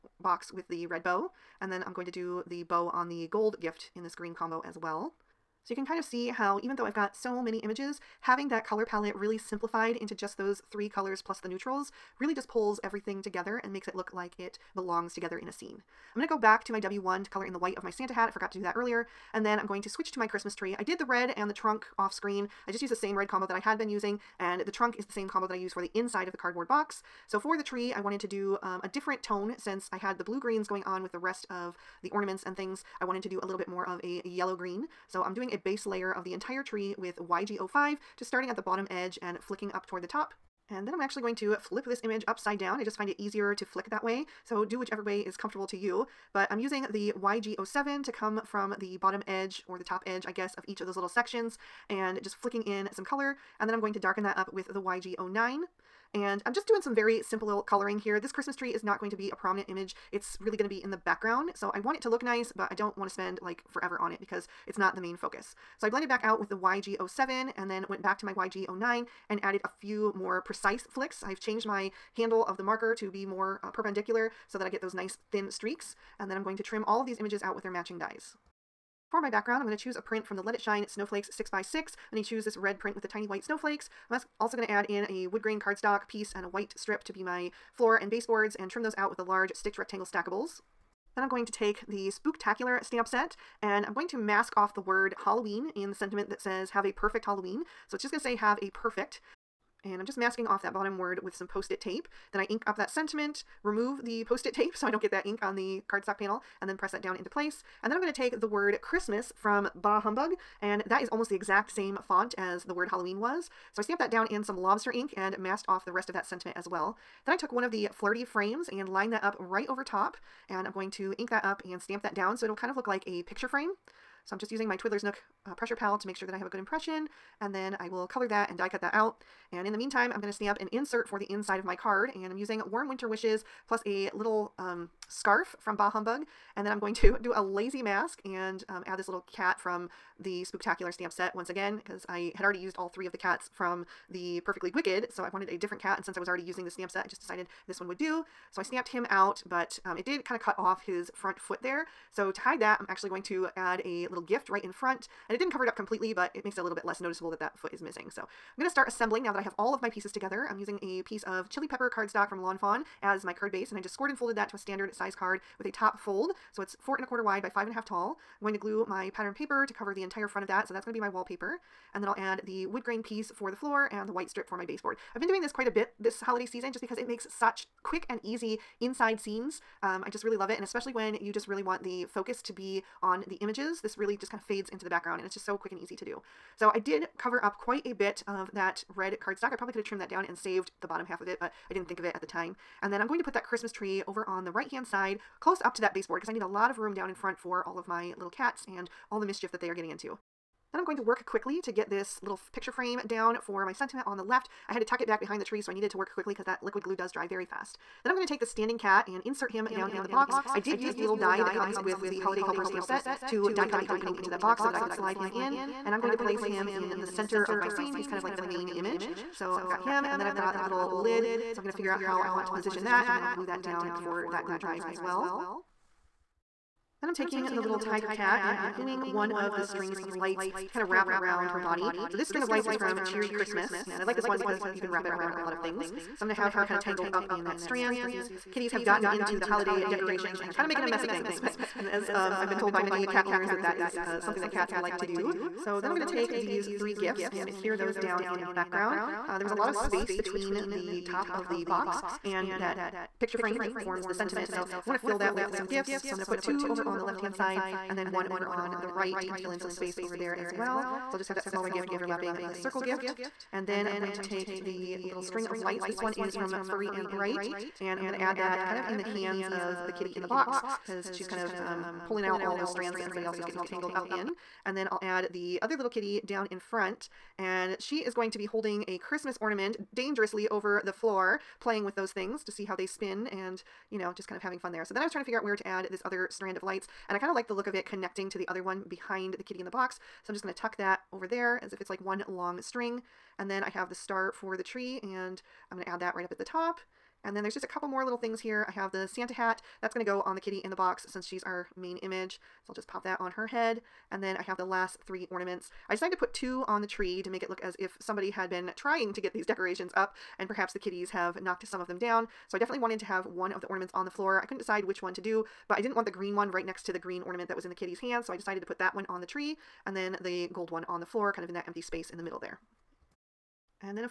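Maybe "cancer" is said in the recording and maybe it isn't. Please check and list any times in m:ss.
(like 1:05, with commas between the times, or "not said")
not said.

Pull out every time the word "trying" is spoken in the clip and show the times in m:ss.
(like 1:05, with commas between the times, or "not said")
4:45, 5:08.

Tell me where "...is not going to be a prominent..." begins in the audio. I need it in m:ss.
0:58.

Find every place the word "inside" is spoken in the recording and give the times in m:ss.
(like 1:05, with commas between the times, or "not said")
0:25, 2:11, 2:58.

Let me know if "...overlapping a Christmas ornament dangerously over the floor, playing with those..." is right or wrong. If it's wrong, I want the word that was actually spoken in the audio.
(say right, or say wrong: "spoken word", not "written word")
wrong: "holding", not "overlapping".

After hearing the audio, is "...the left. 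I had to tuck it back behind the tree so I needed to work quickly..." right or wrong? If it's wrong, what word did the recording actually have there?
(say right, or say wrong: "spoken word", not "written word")
right.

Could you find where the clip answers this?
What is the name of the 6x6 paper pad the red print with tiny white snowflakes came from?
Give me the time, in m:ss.
1:20.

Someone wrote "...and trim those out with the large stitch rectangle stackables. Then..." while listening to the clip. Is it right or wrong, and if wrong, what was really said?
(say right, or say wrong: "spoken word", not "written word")
right.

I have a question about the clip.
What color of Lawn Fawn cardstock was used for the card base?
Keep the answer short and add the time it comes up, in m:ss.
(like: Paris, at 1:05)
chili pepper, at 2:41.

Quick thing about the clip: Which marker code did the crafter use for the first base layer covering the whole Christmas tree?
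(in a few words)
YG05.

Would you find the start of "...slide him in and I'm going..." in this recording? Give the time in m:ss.
3:34.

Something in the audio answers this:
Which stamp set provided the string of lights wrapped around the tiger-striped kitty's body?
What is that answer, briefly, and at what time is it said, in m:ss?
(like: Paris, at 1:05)
Cheery Christmas, at 3:53.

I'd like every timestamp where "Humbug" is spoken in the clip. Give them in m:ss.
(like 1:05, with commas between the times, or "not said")
1:50, 2:15.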